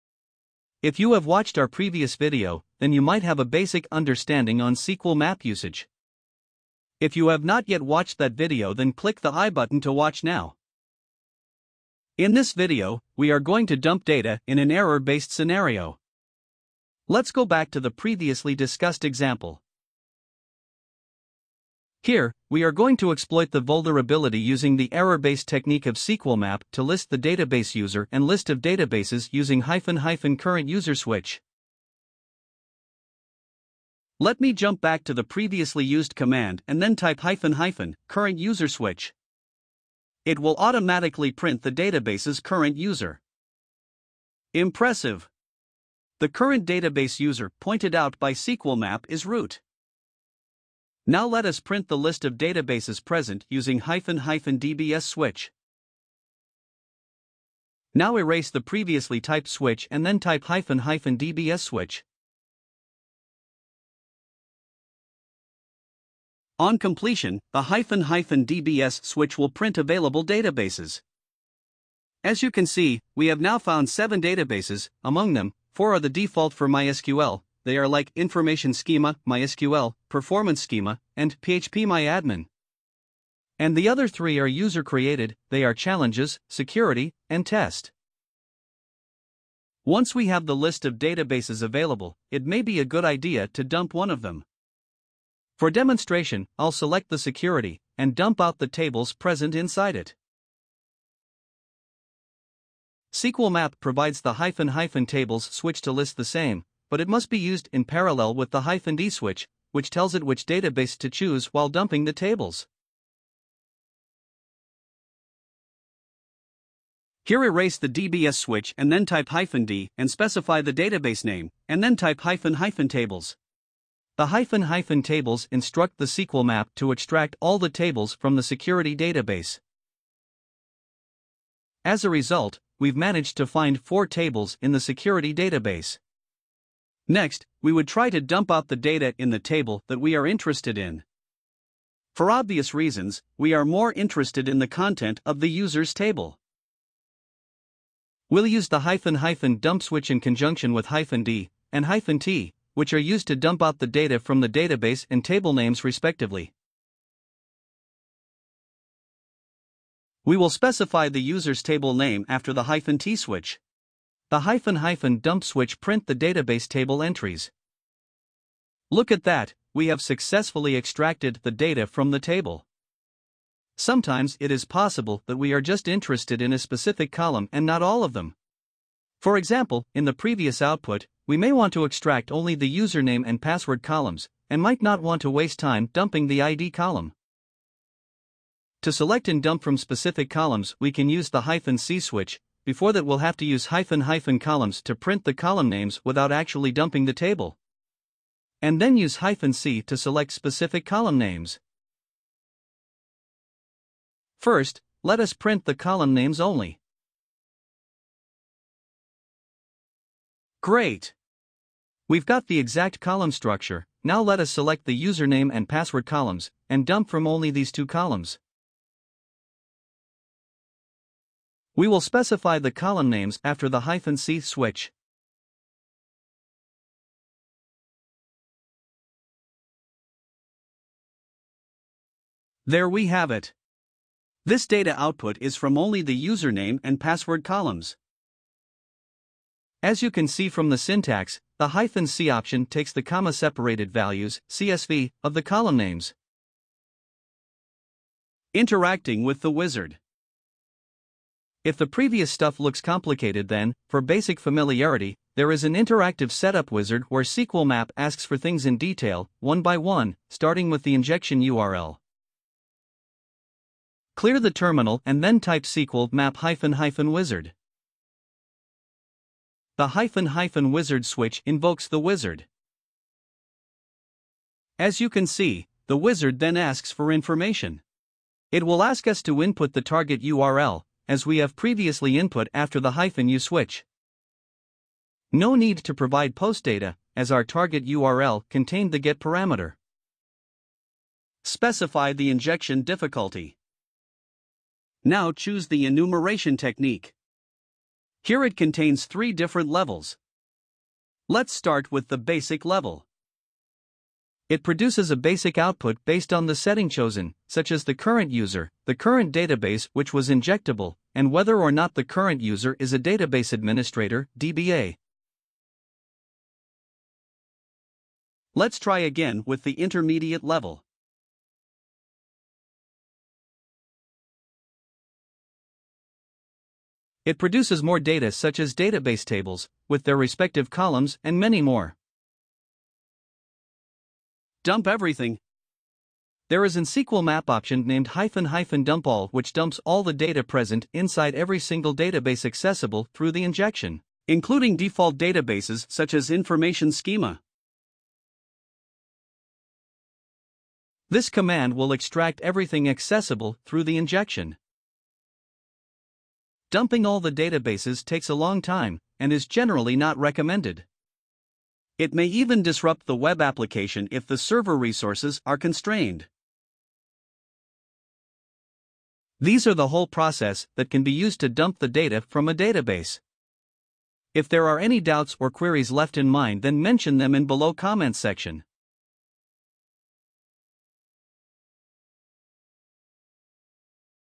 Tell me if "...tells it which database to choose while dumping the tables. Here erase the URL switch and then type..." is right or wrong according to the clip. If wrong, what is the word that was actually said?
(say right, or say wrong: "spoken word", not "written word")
wrong: "DBS", not "URL".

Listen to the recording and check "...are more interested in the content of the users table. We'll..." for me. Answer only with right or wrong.
right.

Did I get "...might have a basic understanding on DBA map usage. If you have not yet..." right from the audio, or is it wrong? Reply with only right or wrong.
wrong.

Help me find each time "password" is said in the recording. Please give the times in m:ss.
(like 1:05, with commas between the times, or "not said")
3:03, 3:35, 3:56.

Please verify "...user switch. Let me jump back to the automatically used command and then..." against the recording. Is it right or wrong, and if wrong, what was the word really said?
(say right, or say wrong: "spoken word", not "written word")
wrong: "previously", not "automatically".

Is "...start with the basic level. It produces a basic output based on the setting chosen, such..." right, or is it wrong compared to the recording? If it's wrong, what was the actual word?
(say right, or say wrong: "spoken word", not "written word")
right.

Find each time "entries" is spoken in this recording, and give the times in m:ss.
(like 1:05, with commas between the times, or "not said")
2:47.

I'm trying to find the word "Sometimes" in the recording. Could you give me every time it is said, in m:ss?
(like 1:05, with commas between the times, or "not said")
2:53.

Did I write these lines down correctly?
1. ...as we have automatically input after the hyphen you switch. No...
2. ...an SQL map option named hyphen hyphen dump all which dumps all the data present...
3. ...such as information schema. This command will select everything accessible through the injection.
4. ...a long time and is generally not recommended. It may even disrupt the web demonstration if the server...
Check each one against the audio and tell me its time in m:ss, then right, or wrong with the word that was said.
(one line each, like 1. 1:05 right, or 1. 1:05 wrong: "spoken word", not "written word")
1. 4:41 wrong: "previously", not "automatically"
2. 5:36 right
3. 5:45 wrong: "extract", not "select"
4. 5:58 wrong: "application", not "demonstration".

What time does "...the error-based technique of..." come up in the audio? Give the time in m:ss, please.
0:24.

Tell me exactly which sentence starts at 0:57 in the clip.
Now erase the previously typed switch and then type hyphen hyphen dbs switch.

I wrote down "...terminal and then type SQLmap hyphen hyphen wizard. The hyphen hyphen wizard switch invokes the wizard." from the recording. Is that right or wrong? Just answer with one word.
right.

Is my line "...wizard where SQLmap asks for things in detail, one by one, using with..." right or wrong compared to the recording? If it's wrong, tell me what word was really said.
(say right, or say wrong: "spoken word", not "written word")
wrong: "starting", not "using".